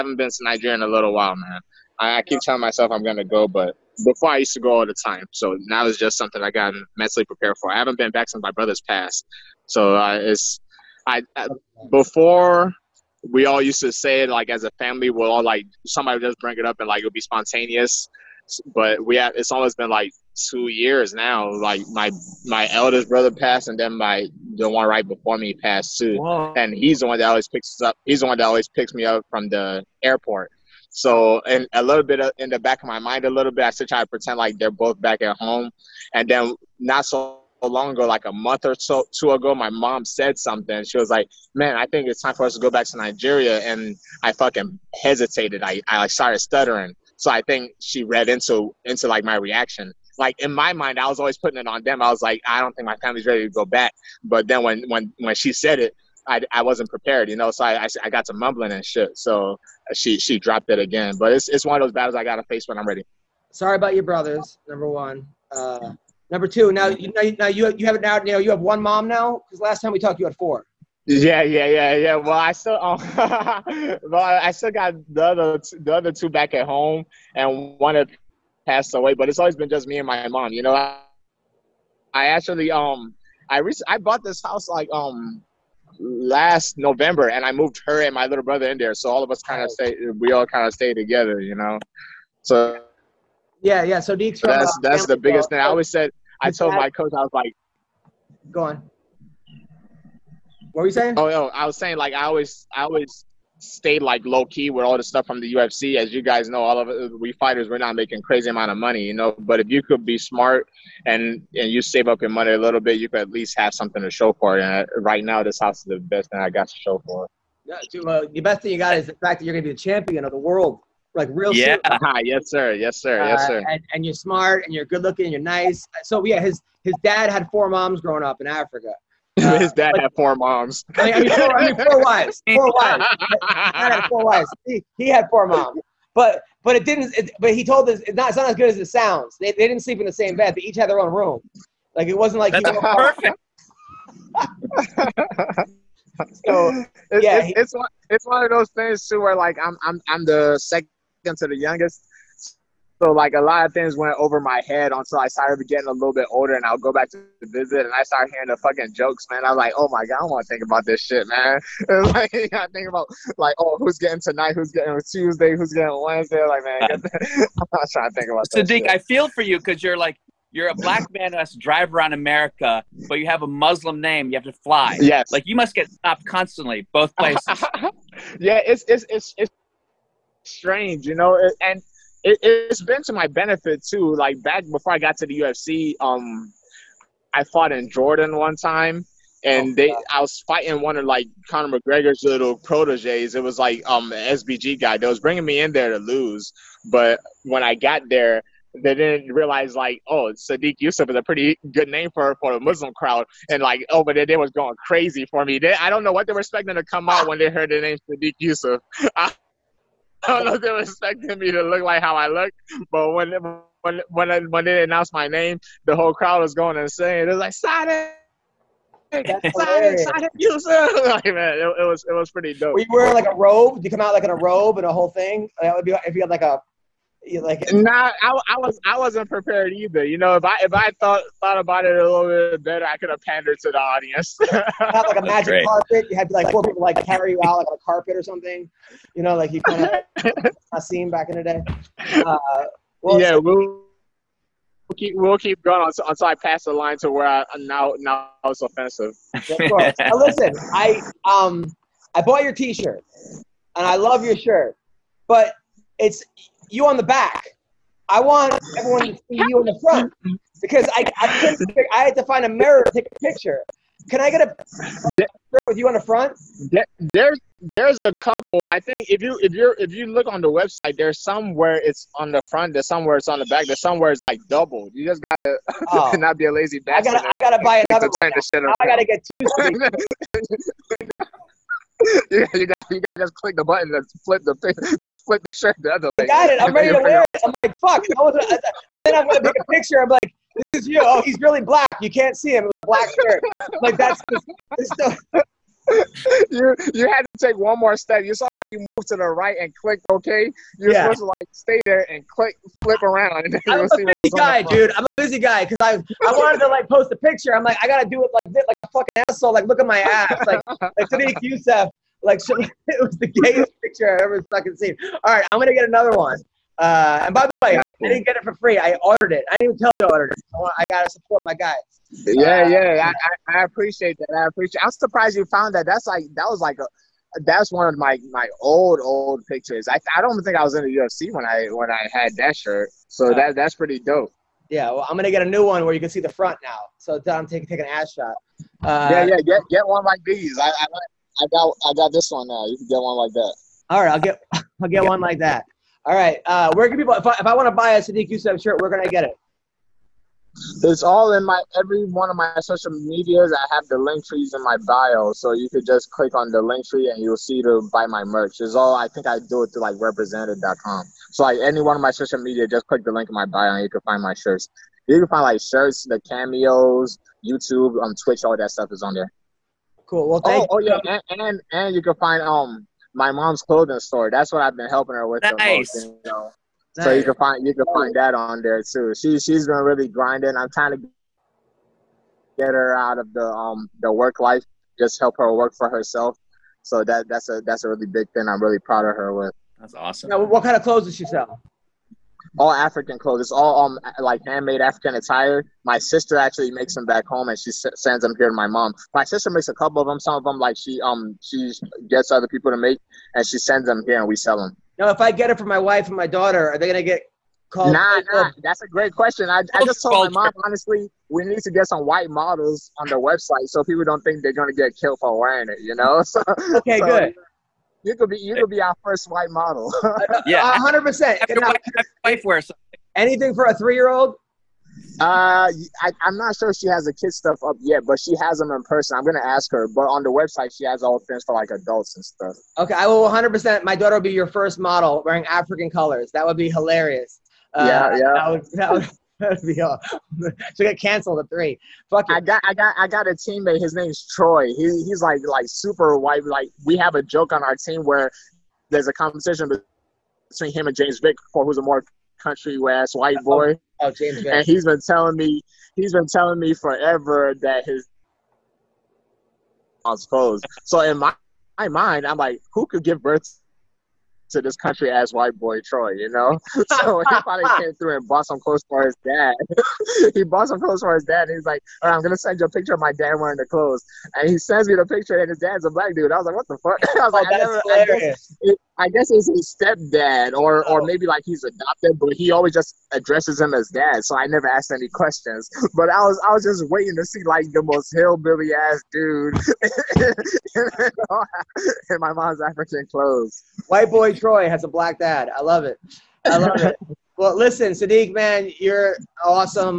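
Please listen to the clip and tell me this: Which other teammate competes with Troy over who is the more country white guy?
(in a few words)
James Vick.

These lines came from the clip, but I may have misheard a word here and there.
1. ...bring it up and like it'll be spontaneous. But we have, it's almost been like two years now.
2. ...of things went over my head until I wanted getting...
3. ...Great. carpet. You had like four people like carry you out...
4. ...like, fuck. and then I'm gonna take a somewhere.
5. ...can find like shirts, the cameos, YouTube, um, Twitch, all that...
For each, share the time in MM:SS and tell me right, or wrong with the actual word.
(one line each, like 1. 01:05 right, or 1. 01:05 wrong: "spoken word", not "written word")
1. 00:16 right
2. 02:33 wrong: "started", not "wanted"
3. 03:55 right
4. 04:47 wrong: "picture", not "somewhere"
5. 06:05 right.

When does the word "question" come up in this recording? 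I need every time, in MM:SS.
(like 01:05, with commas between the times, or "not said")
06:49, 08:05.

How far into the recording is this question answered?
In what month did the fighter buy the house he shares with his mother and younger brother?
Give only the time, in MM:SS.
01:26.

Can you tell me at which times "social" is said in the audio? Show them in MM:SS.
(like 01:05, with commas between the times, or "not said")
05:52, 06:02.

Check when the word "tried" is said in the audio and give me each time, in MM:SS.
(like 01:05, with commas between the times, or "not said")
not said.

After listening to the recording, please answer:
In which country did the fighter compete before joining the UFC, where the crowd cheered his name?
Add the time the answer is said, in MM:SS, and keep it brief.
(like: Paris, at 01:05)
Jordan, at 03:07.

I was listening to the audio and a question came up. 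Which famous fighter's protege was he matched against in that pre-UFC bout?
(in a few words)
Conor McGregor.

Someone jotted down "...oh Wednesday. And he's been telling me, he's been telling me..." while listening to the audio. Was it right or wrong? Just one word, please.
wrong.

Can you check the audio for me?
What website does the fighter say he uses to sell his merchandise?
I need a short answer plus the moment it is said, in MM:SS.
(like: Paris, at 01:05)
represented.com, at 05:59.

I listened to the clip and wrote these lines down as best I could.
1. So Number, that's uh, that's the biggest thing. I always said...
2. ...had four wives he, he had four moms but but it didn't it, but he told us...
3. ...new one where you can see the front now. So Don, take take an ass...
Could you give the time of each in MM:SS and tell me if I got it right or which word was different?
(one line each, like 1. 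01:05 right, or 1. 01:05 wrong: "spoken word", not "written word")
1. 01:33 wrong: "Deeks", not "Number"
2. 02:13 right
3. 05:35 right.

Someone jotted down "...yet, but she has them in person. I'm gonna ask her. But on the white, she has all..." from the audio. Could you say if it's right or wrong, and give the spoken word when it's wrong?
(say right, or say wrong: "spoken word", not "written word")
wrong: "website", not "white".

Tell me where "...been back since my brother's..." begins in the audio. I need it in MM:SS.
00:07.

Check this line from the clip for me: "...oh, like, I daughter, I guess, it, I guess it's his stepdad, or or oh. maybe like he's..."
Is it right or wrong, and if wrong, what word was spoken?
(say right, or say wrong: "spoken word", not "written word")
wrong: "never", not "daughter".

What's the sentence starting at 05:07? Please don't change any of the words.
I'm like I gotta do it like this, like a fucking asshole.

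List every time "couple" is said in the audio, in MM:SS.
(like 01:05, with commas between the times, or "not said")
04:28, 06:39.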